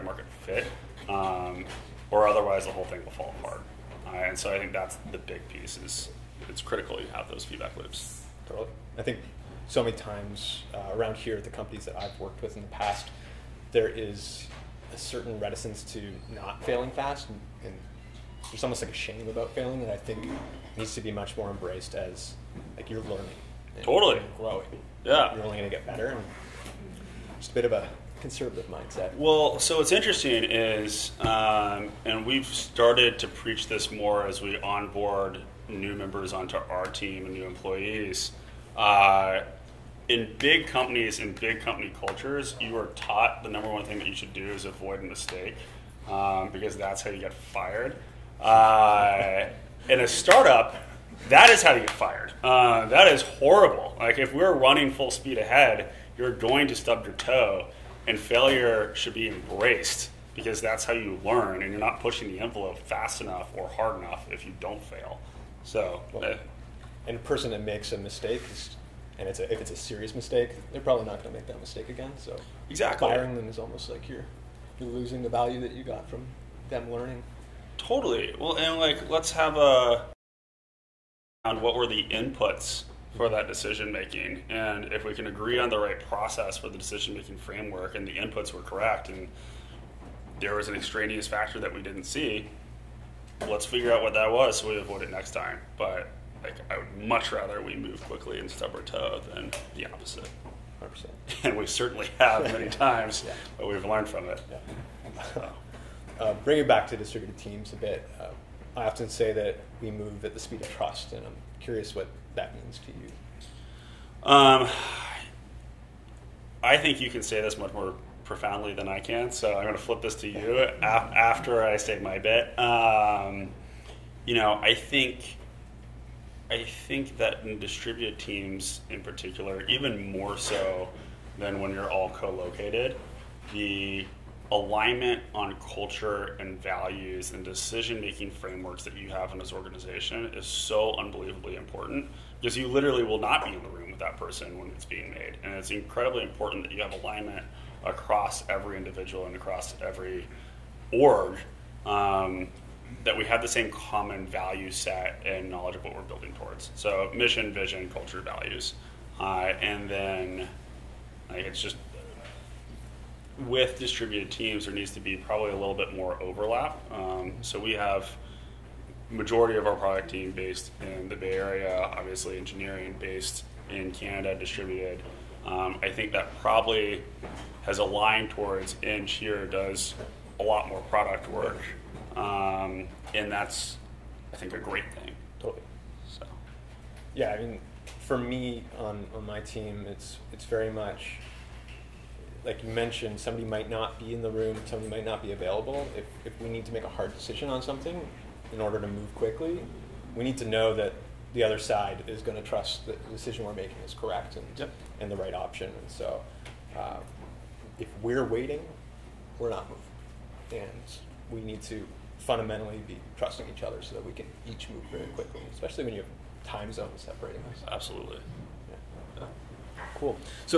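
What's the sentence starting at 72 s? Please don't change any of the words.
So exactly, firing them is almost like you're you're losing the value that you got from them learning.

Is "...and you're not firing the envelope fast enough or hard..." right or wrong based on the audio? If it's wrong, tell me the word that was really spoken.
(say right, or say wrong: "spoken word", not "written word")
wrong: "pushing", not "firing".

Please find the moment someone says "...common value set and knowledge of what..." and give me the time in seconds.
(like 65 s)
153 s.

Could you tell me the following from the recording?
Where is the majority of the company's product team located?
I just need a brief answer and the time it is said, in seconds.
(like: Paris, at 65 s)
Bay Area, at 171 s.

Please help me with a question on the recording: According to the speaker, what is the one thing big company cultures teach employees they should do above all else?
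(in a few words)
Avoid a mistake.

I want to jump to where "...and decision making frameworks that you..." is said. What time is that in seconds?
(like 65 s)
137 s.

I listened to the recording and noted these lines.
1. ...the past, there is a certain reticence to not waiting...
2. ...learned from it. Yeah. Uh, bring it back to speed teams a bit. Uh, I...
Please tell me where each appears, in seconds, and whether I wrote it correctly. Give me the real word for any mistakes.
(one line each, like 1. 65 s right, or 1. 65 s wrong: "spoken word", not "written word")
1. 12 s wrong: "failing", not "waiting"
2. 103 s wrong: "distributed", not "speed".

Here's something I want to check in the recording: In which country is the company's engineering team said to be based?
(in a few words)
Canada.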